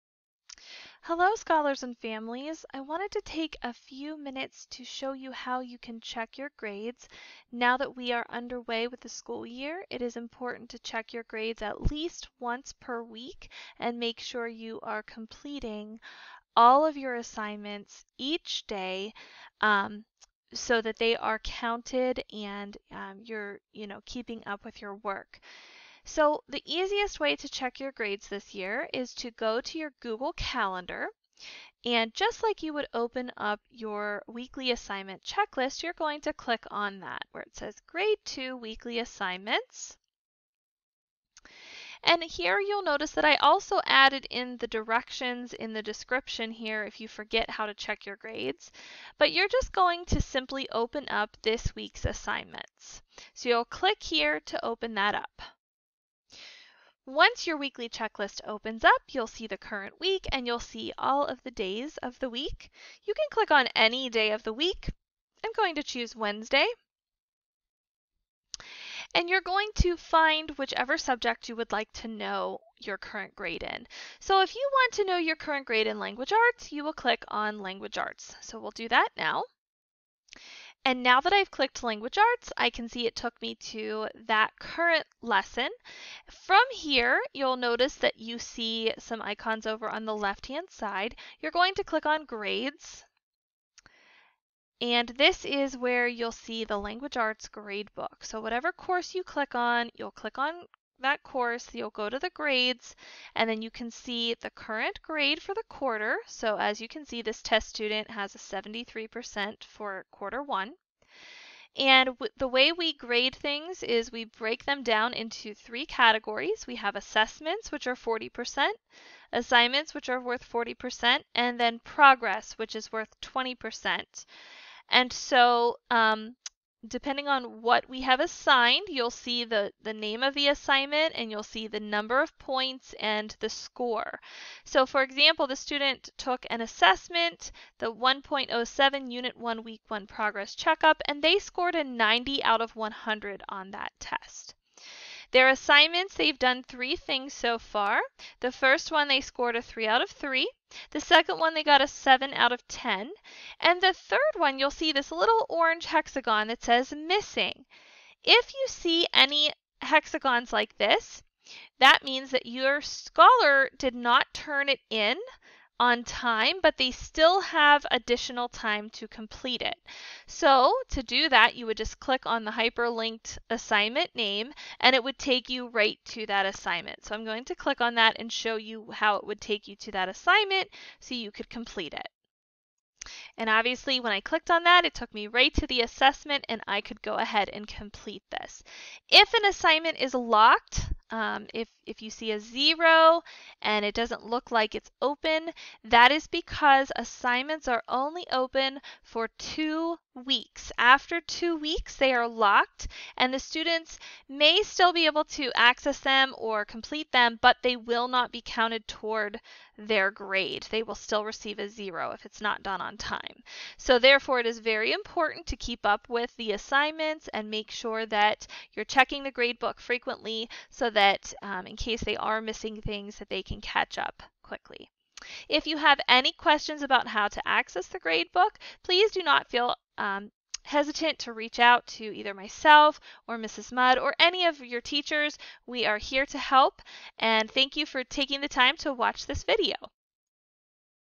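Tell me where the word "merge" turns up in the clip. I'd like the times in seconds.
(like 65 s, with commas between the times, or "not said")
not said.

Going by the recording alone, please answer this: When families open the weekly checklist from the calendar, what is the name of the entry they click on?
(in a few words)
Grade 2 Weekly Assignments.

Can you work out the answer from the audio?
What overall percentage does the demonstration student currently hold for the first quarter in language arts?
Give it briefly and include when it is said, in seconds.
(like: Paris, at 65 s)
73%, at 108 s.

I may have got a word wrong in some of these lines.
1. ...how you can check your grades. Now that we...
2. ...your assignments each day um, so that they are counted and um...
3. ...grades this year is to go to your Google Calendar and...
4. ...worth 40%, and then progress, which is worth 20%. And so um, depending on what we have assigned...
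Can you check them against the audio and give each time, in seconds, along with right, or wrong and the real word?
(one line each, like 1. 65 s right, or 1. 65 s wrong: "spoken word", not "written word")
1. 5 s right
2. 16 s right
3. 27 s right
4. 120 s right.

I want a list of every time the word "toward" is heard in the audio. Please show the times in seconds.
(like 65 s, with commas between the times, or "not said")
208 s.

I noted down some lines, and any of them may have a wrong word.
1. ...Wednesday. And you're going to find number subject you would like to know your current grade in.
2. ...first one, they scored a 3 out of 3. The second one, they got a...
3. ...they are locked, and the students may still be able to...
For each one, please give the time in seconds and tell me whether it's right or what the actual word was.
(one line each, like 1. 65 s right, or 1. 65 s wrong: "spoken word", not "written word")
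1. 66 s wrong: "whichever", not "number"
2. 148 s right
3. 201 s right.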